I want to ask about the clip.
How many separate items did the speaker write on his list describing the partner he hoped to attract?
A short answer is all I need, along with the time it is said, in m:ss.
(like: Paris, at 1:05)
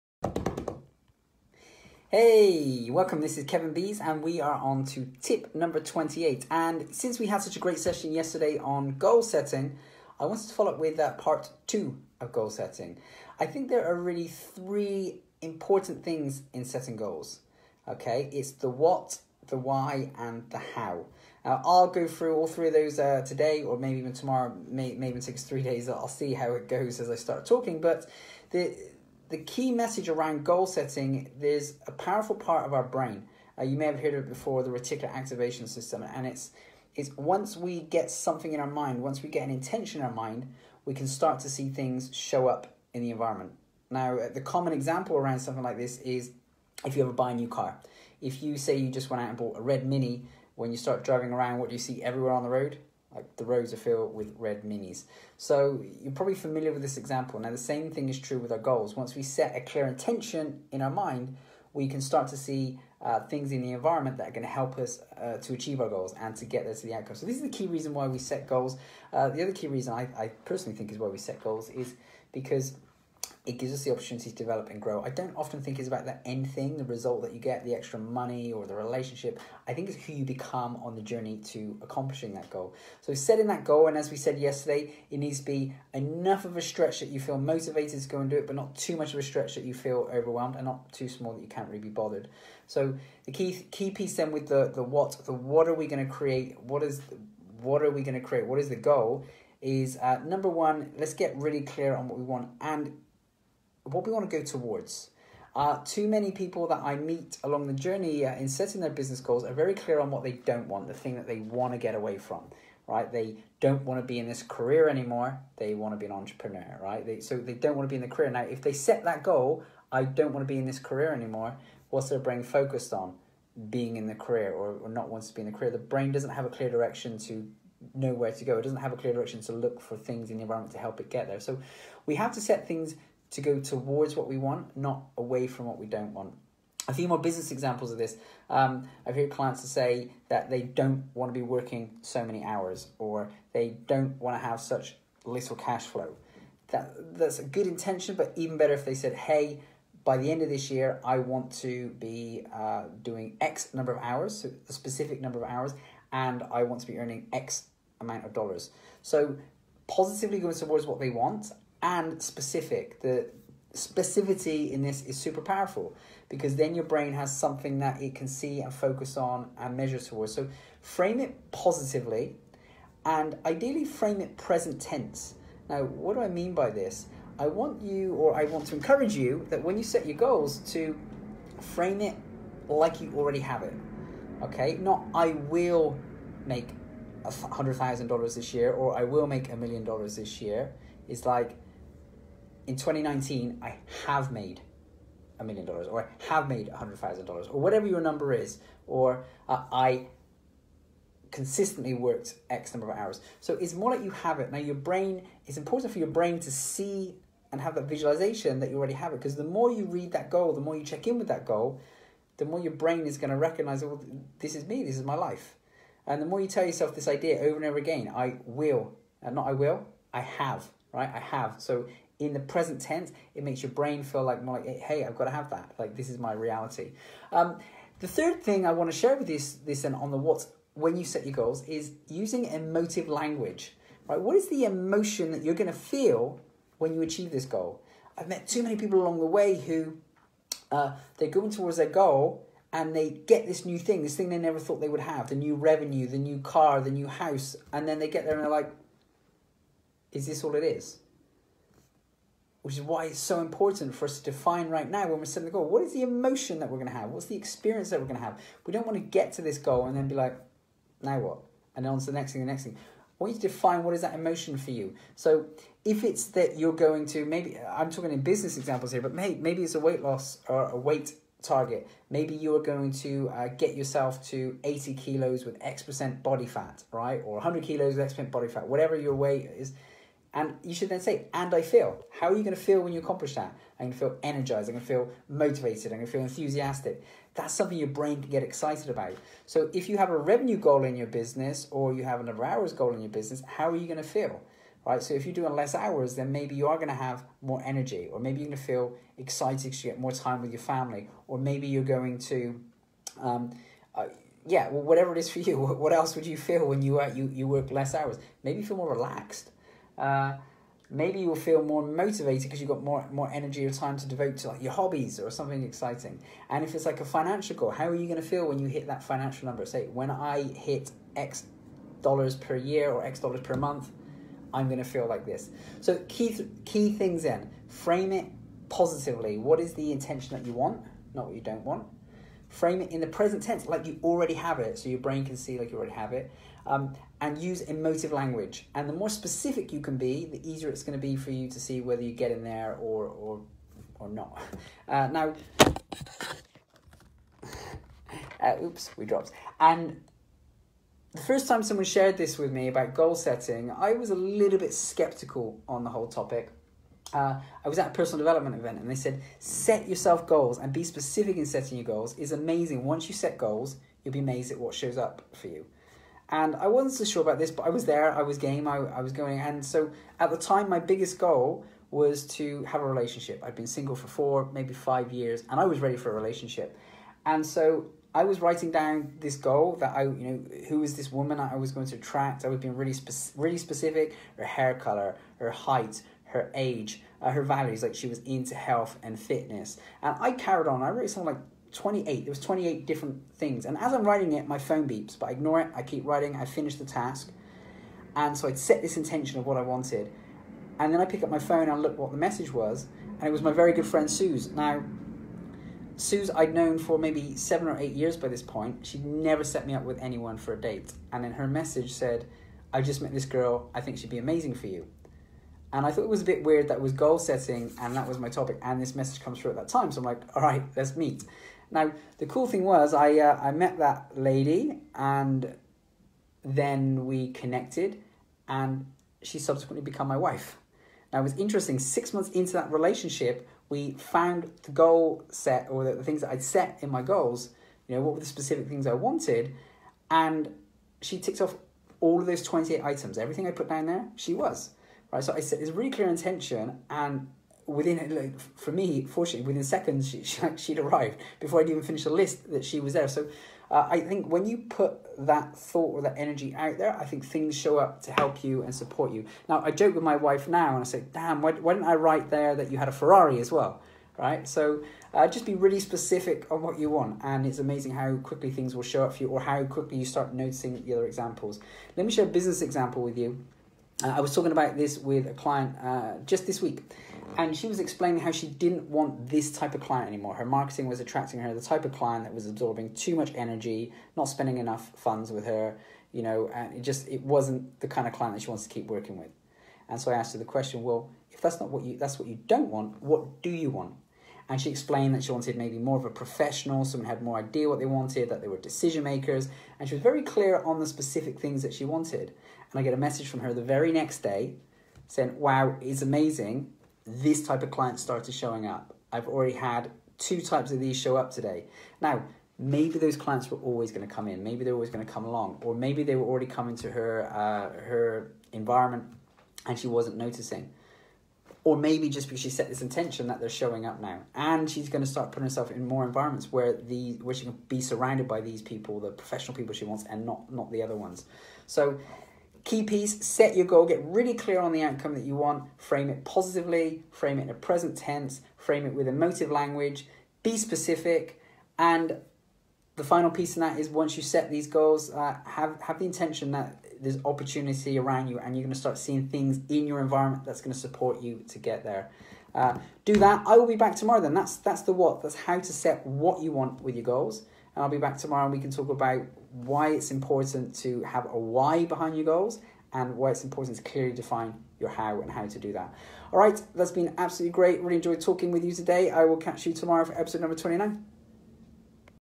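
28, at 6:32.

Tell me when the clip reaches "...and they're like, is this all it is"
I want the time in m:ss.
4:08.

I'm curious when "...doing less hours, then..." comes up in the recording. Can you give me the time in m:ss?
4:55.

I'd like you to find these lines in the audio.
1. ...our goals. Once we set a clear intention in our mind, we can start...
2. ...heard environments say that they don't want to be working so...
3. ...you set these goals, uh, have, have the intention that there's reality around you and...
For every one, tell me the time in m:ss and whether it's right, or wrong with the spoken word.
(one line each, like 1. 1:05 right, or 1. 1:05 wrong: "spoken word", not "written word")
1. 0:58 right
2. 2:19 wrong: "clients", not "environments"
3. 9:04 wrong: "opportunity", not "reality".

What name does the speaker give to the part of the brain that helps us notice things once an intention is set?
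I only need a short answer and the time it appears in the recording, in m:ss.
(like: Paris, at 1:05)
reticular activation system, at 0:34.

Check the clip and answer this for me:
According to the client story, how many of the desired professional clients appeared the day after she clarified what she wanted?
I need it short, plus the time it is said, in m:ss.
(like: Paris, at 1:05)
2, at 8:30.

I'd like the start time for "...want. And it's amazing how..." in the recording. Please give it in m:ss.
7:46.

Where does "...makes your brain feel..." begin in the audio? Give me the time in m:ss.
3:43.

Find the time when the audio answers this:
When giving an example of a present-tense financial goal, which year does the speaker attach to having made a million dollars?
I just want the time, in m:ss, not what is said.
3:12.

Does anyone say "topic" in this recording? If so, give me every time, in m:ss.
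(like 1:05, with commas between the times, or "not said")
5:56, 6:58.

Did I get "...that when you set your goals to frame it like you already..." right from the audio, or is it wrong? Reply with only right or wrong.
right.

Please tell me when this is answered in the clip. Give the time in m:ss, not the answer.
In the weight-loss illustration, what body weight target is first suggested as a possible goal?
4:34.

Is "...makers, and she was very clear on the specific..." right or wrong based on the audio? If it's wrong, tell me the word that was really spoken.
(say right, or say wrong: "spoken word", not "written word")
right.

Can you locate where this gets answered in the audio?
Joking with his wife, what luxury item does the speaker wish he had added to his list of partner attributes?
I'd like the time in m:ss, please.
7:42.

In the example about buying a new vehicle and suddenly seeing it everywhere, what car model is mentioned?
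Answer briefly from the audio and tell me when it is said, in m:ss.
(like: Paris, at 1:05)
red Mini, at 0:49.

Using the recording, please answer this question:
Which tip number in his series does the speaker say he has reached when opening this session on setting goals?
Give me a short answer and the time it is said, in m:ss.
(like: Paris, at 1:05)
28, at 0:05.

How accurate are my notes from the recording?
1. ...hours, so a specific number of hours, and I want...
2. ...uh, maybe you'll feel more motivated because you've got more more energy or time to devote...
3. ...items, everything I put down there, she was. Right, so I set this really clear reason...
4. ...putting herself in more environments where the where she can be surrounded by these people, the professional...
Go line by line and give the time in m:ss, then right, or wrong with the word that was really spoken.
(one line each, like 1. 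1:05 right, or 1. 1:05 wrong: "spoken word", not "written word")
1. 2:34 right
2. 5:10 right
3. 7:22 wrong: "intention", not "reason"
4. 8:45 right.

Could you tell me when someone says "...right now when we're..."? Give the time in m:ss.
4:14.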